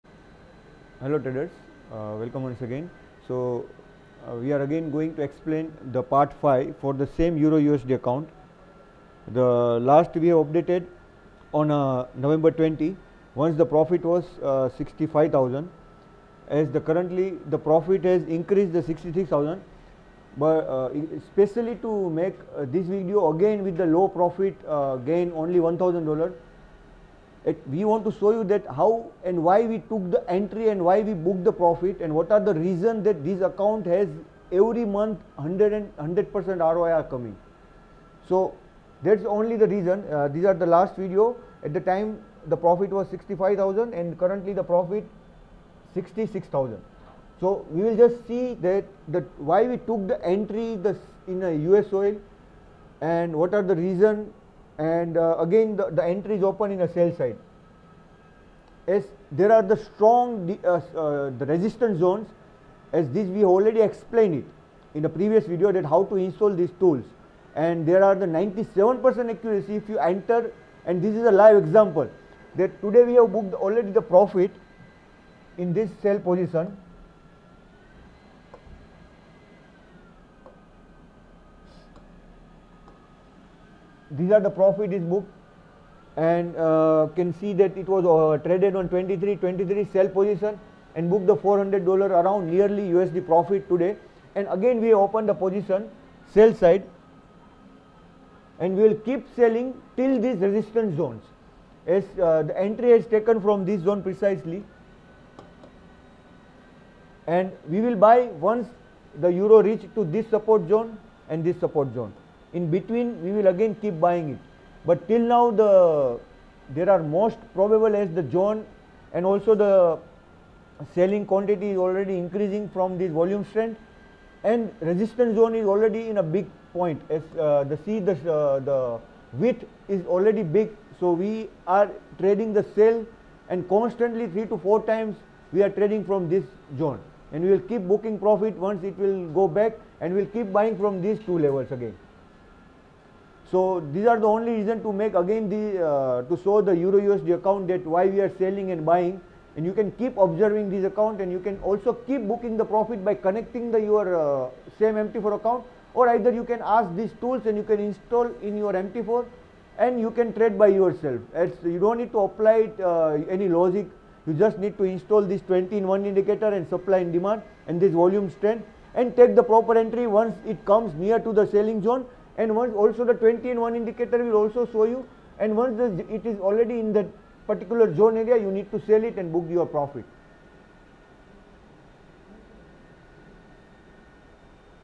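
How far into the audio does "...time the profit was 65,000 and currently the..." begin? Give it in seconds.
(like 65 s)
41 s.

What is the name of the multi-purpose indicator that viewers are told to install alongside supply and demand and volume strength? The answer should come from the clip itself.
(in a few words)
20 in 1 indicator.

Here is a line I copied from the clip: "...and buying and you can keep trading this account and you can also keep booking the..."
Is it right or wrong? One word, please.
wrong.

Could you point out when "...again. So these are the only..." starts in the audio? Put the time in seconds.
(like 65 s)
141 s.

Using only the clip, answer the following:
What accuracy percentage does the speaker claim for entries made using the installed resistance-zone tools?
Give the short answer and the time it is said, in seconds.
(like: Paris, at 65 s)
97%, at 68 s.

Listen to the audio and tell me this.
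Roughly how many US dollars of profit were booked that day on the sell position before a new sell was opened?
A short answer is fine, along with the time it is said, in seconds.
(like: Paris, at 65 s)
400, at 91 s.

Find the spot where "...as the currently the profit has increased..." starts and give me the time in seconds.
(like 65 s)
16 s.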